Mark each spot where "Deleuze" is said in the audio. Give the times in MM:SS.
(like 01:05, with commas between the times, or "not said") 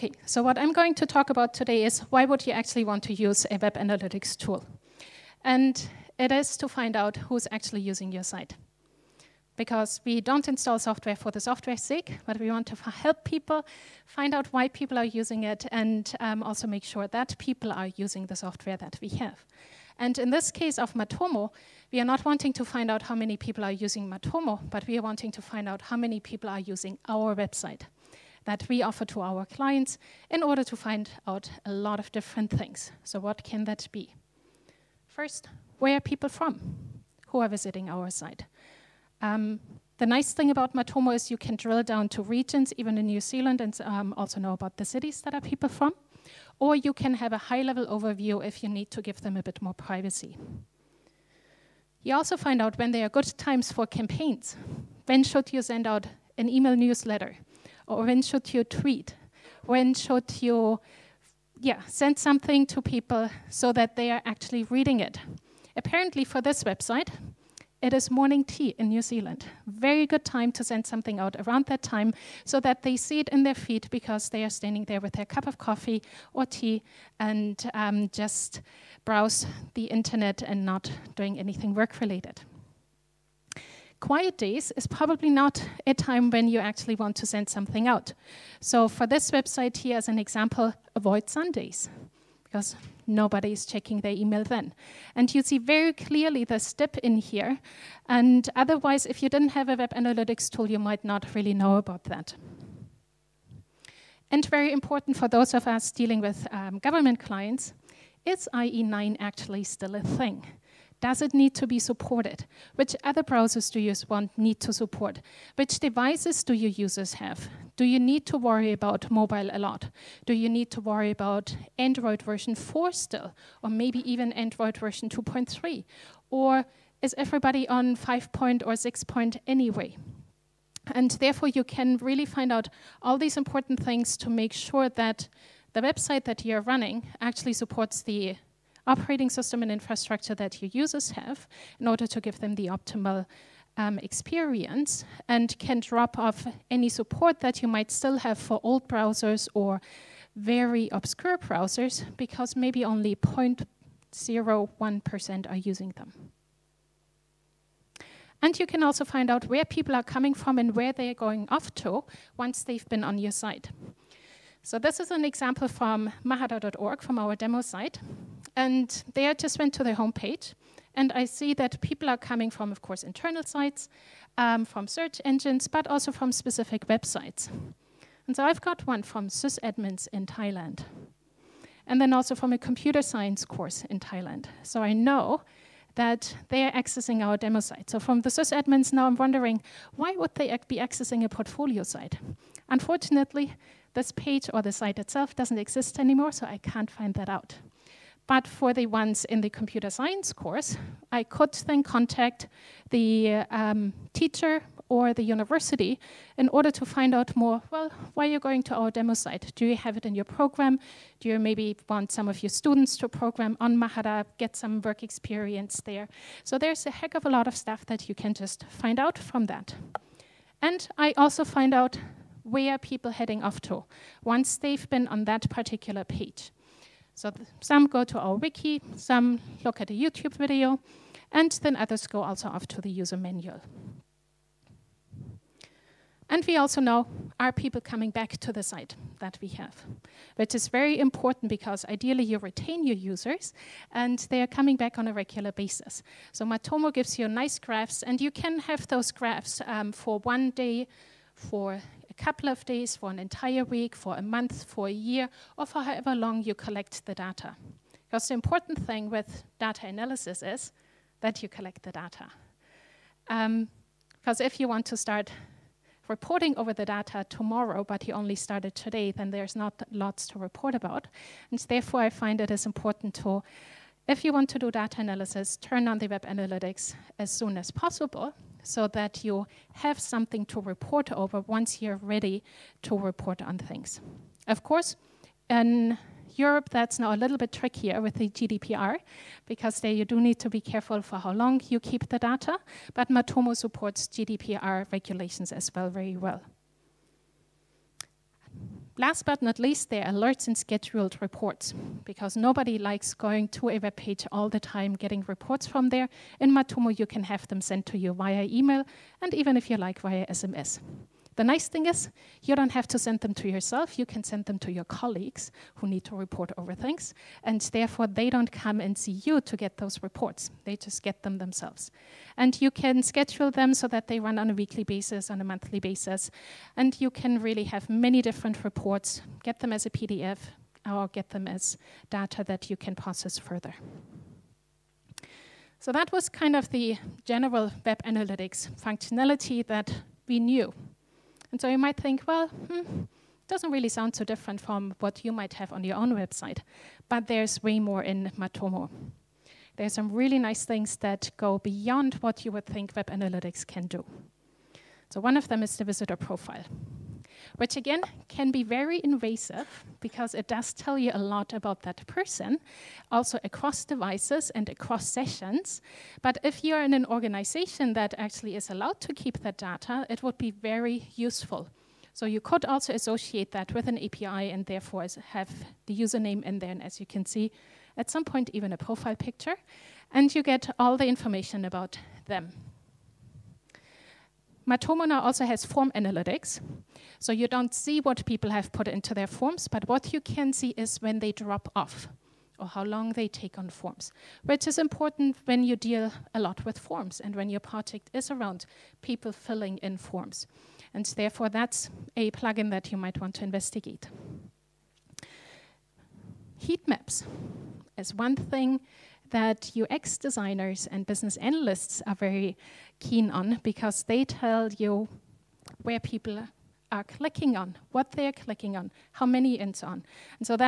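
not said.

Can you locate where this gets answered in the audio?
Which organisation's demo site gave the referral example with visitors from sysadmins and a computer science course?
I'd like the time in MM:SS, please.
02:46.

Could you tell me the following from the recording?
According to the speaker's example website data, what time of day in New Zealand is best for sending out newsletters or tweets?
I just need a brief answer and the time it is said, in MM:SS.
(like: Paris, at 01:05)
morning tea, at 01:08.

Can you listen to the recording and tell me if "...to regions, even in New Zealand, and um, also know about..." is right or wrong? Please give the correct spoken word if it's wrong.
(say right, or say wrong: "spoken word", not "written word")
right.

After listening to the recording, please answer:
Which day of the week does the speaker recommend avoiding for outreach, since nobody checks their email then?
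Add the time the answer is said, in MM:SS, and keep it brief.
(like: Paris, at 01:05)
Sundays, at 01:31.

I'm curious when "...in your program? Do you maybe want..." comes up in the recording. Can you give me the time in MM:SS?
03:30.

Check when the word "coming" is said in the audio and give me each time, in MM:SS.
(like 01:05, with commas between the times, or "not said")
02:40, 02:52, 03:57, 04:04.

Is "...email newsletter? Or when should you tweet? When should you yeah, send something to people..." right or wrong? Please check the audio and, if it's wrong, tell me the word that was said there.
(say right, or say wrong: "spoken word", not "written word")
right.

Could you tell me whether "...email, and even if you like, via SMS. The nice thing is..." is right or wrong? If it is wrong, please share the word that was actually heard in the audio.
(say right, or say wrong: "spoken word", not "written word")
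right.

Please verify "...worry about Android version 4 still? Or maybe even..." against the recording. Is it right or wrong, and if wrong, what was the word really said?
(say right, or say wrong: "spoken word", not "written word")
right.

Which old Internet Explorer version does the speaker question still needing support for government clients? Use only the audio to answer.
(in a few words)
IE9.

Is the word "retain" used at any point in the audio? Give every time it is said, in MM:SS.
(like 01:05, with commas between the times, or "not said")
04:02.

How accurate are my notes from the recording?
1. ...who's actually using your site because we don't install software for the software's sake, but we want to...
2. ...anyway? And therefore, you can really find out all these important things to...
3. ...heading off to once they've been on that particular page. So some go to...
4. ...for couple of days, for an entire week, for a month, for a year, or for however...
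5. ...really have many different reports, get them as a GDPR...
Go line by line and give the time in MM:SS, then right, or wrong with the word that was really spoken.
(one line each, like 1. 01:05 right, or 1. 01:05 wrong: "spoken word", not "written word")
1. 00:07 right
2. 02:09 right
3. 03:43 right
4. 04:11 right
5. 05:27 wrong: "PDF", not "GDPR".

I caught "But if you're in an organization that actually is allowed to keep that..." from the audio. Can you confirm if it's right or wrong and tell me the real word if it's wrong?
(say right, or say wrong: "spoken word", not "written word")
right.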